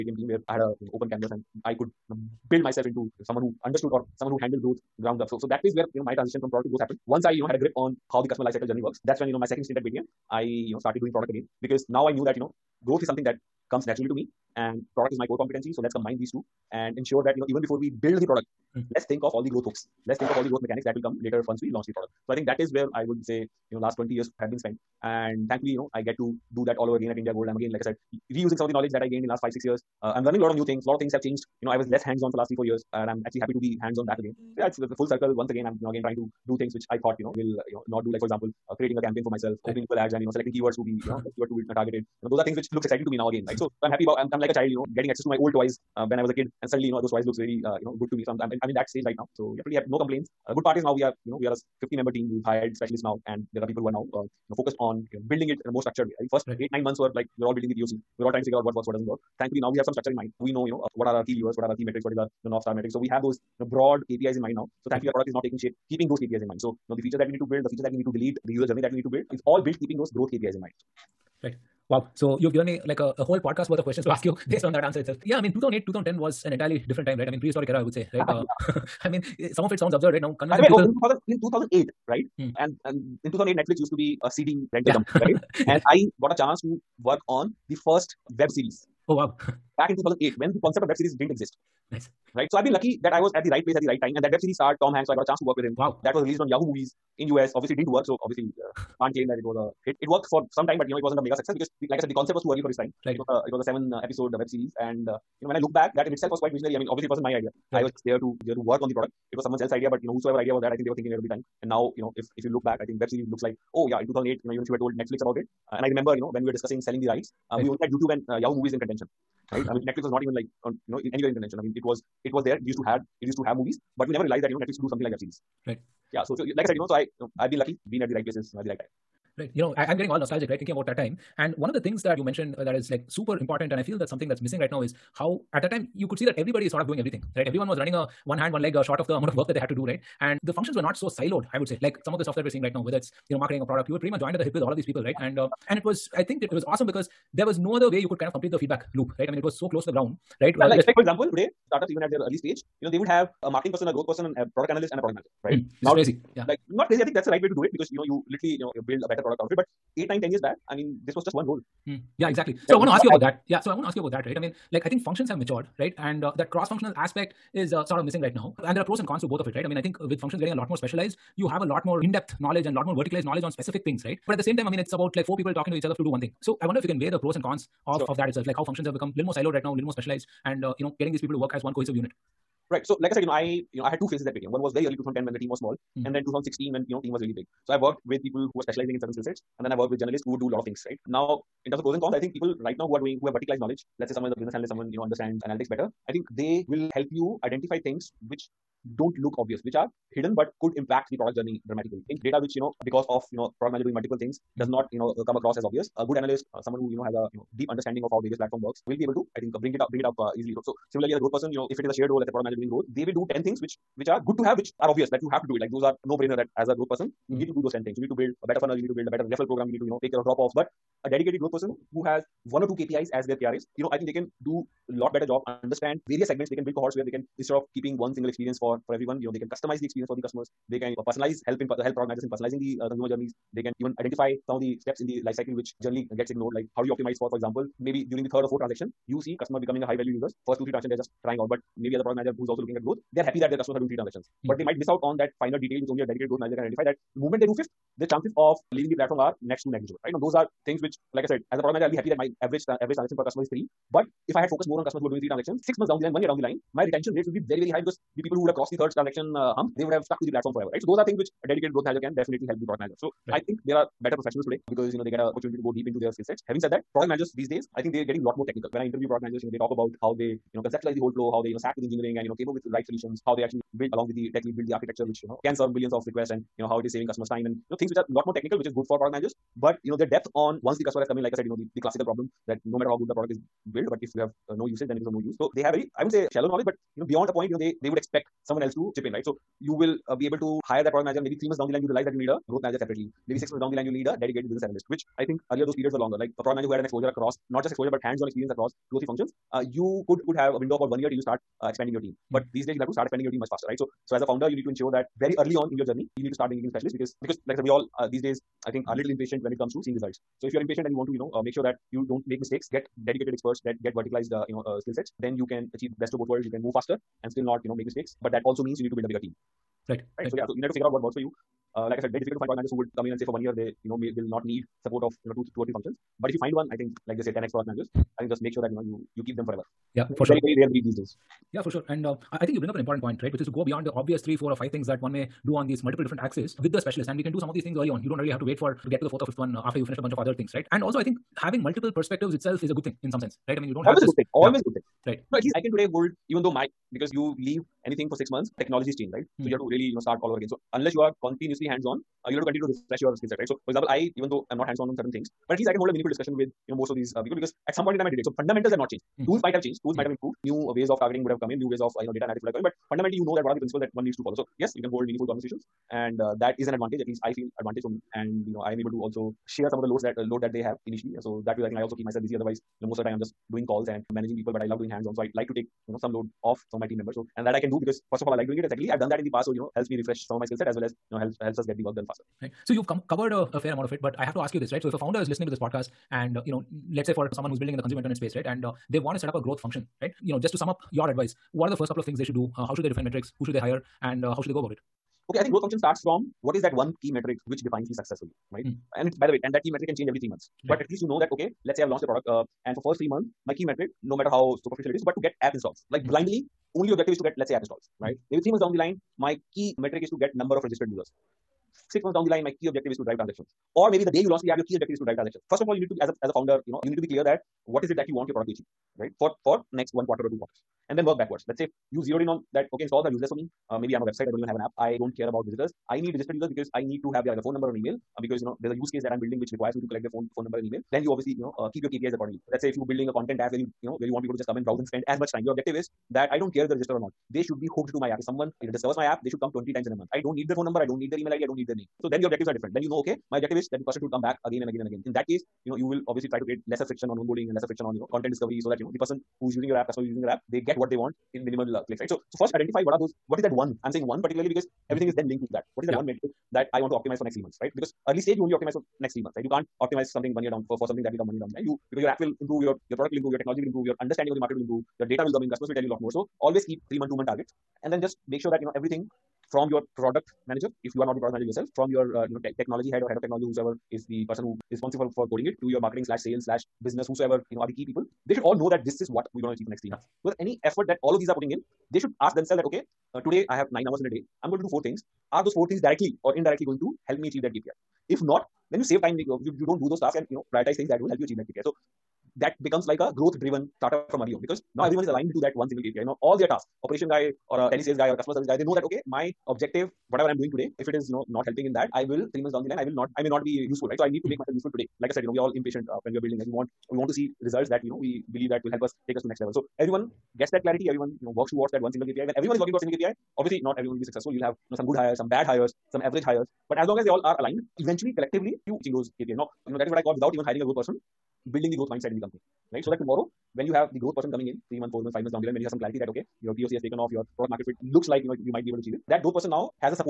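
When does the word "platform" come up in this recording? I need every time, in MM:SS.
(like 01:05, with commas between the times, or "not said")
03:28, 04:08, 04:20.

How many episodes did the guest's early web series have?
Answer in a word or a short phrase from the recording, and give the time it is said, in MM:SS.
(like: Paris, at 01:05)
7, at 01:43.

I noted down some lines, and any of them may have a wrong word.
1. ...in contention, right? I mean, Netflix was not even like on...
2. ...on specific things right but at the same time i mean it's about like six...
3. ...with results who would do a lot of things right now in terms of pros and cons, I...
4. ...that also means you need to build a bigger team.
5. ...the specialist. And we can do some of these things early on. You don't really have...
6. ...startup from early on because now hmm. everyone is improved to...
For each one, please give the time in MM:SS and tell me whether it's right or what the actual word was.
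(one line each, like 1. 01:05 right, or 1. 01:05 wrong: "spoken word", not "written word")
1. 01:58 right
2. 02:53 wrong: "four", not "six"
3. 03:09 wrong: "journalists", not "results"
4. 05:18 right
5. 05:36 right
6. 08:13 wrong: "aligned", not "improved".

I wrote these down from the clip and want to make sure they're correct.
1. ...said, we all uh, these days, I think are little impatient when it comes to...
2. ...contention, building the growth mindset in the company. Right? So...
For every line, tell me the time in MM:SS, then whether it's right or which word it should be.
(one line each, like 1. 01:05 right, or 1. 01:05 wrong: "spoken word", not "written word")
1. 05:07 right
2. 08:40 wrong: "person", not "contention".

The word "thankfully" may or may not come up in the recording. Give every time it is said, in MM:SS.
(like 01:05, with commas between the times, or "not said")
00:25, 00:59, 01:04.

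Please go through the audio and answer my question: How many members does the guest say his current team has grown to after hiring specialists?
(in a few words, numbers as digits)
50.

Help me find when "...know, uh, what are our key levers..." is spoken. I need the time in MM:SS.
01:00.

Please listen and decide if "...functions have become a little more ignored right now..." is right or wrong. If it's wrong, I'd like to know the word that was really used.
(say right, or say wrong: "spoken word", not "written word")
wrong: "siloed", not "ignored".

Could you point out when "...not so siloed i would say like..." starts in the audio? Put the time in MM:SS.
02:20.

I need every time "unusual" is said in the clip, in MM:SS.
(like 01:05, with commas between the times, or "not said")
not said.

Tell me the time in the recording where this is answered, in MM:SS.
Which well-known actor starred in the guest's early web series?
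01:34.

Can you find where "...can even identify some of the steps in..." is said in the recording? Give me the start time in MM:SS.
03:53.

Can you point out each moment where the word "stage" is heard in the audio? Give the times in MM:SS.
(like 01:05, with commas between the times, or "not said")
00:48, 02:32, 07:38.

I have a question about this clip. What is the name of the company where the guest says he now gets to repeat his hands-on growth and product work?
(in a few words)
Indiagold.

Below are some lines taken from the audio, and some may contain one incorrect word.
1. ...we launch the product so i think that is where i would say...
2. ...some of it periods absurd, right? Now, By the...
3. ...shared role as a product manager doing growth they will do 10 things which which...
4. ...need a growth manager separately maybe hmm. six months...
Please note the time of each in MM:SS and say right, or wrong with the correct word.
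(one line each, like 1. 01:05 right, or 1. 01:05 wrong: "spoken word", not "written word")
1. 00:21 right
2. 01:19 wrong: "sounds", not "periods"
3. 03:31 right
4. 04:52 right.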